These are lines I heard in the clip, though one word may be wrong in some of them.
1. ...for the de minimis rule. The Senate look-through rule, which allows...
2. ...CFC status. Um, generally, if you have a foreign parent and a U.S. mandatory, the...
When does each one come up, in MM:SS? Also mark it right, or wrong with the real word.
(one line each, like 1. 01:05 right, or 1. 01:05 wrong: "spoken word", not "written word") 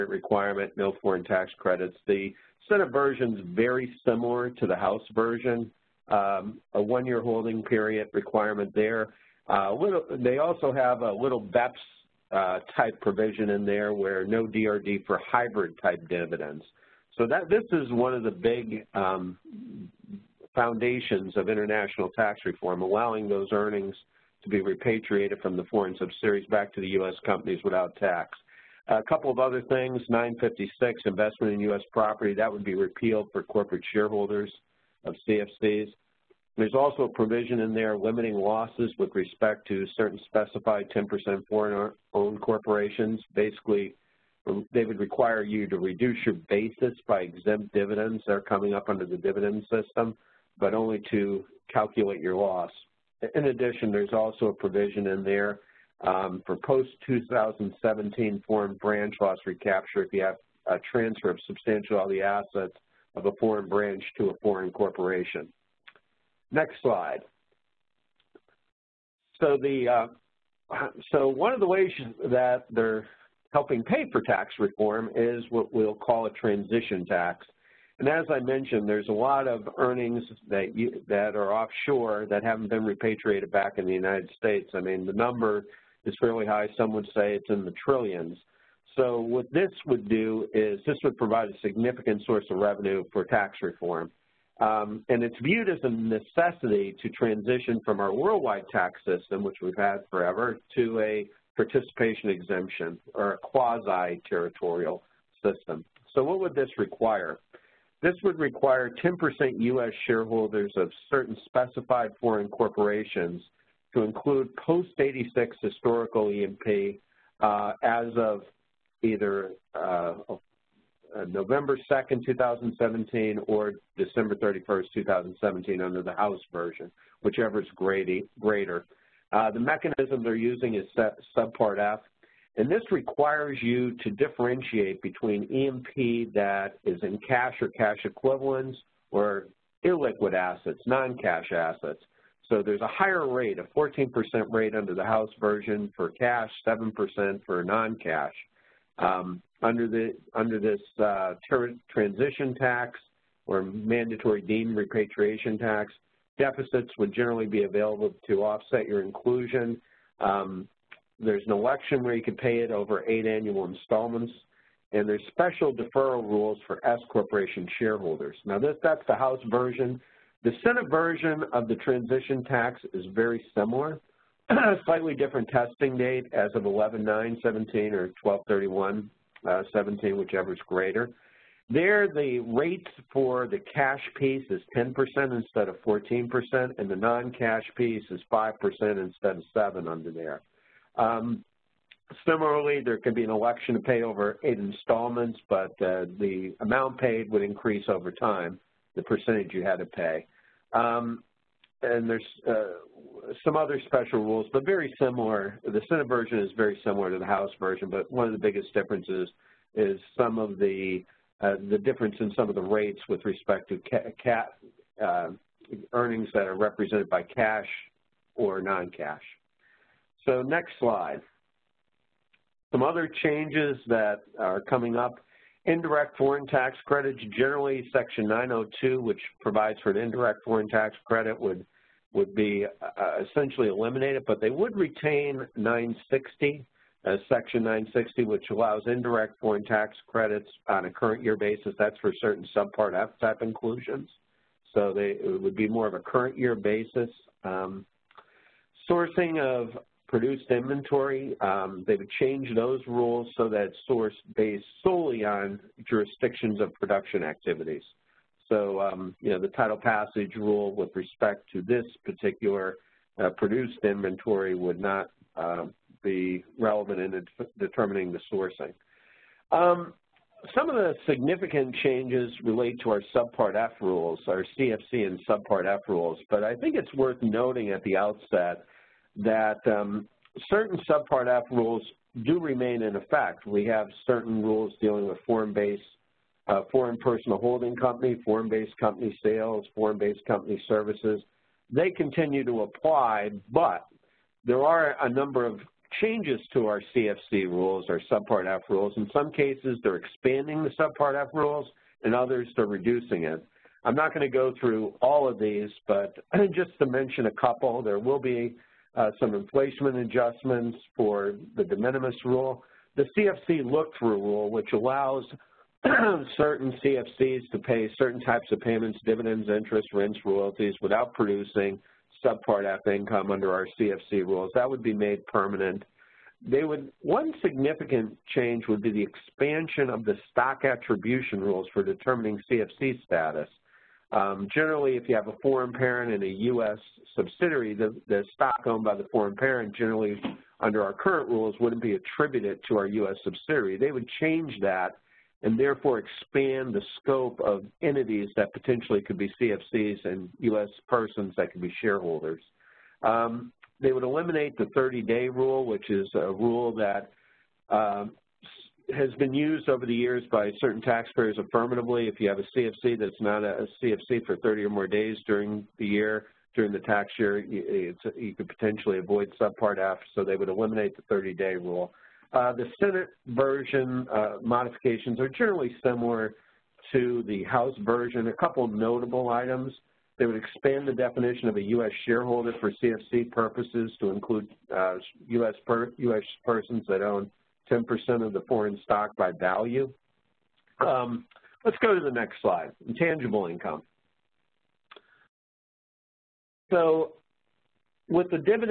1. 05:10 wrong: "CFC", not "Senate"
2. 05:32 wrong: "subsidiary", not "mandatory".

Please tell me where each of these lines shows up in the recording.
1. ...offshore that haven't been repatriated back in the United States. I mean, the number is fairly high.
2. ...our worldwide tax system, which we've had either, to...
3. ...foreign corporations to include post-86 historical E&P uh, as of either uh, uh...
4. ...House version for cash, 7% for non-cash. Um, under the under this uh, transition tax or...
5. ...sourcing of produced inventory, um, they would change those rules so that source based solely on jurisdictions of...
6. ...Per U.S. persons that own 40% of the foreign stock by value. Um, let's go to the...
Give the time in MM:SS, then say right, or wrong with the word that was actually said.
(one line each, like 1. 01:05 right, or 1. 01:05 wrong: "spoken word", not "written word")
1. 01:21 right
2. 01:38 wrong: "forever", not "either"
3. 01:52 right
4. 02:25 right
5. 04:08 right
6. 06:25 wrong: "10", not "40".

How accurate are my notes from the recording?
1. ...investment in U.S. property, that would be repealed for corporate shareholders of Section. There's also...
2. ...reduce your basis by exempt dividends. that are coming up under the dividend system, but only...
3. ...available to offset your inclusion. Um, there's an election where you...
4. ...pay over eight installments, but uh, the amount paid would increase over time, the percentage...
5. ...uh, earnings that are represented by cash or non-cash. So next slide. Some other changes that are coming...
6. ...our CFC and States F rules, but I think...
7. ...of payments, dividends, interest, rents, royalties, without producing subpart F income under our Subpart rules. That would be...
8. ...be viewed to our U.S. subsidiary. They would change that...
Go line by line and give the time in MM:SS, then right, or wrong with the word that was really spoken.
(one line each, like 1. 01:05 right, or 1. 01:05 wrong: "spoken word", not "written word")
1. 00:31 wrong: "CFCs", not "Section"
2. 00:45 right
3. 02:37 right
4. 03:13 right
5. 03:35 right
6. 04:34 wrong: "Subpart", not "States"
7. 05:18 wrong: "CFC", not "Subpart"
8. 05:41 wrong: "attributed", not "viewed".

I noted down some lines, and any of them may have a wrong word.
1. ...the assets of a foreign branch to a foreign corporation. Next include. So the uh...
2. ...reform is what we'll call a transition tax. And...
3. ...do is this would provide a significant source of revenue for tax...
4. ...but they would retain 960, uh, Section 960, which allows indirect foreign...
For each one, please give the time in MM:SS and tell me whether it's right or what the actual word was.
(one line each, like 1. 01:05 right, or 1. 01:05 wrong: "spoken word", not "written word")
1. 01:02 wrong: "slide", not "include"
2. 01:14 right
3. 01:30 right
4. 03:54 right.